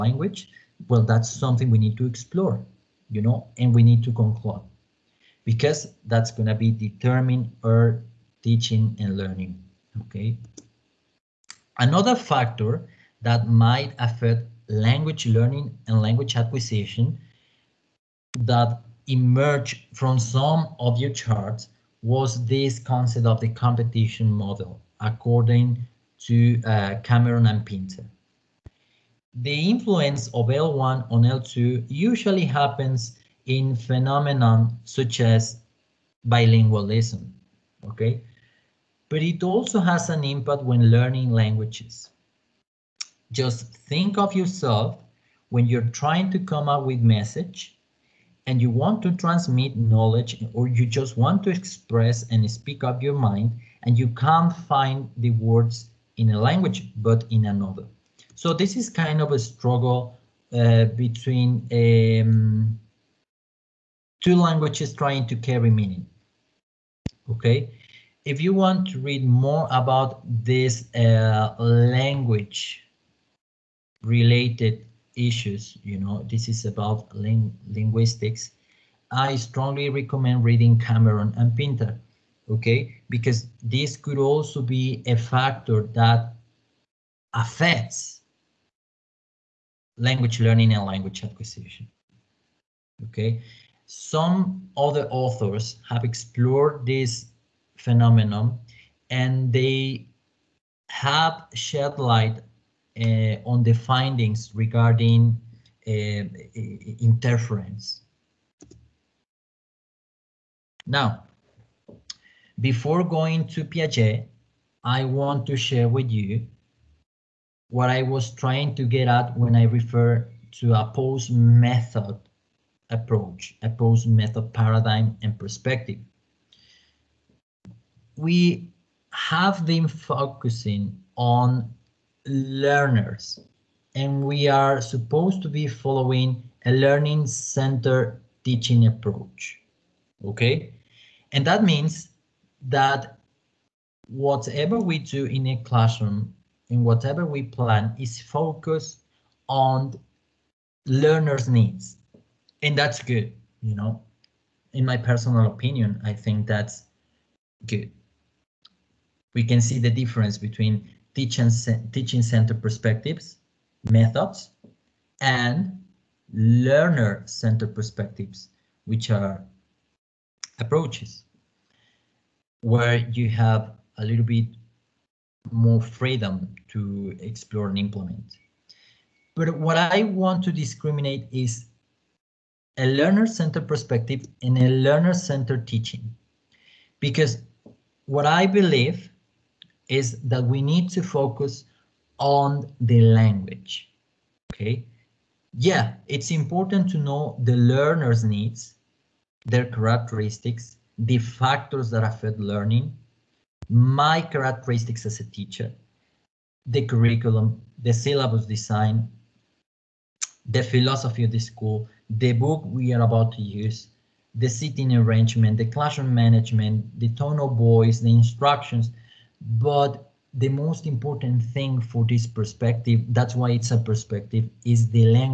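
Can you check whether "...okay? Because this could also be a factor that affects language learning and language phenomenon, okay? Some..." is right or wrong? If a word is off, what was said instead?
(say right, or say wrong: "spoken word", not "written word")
wrong: "acquisition", not "phenomenon".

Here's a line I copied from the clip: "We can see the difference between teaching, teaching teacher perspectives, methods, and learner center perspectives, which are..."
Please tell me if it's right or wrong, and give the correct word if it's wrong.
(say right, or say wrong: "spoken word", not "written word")
wrong: "center", not "teacher".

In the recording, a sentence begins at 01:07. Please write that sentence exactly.
Okay, if you want to read more about this uh, language related issues.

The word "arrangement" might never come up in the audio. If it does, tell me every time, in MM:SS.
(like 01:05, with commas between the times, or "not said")
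03:34.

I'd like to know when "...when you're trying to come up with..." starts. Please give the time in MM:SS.
00:45.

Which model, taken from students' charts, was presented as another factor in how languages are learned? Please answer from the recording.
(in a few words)
competition model.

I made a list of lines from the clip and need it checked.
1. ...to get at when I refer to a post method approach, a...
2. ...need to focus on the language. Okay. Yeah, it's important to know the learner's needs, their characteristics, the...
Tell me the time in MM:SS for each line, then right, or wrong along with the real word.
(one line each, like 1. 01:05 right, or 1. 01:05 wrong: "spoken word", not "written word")
1. 01:58 right
2. 03:10 right.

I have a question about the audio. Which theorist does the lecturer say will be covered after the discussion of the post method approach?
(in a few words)
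Piaget.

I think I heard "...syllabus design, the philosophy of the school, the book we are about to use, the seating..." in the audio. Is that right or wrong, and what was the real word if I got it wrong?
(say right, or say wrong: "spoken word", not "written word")
right.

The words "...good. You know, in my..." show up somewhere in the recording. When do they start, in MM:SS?
02:33.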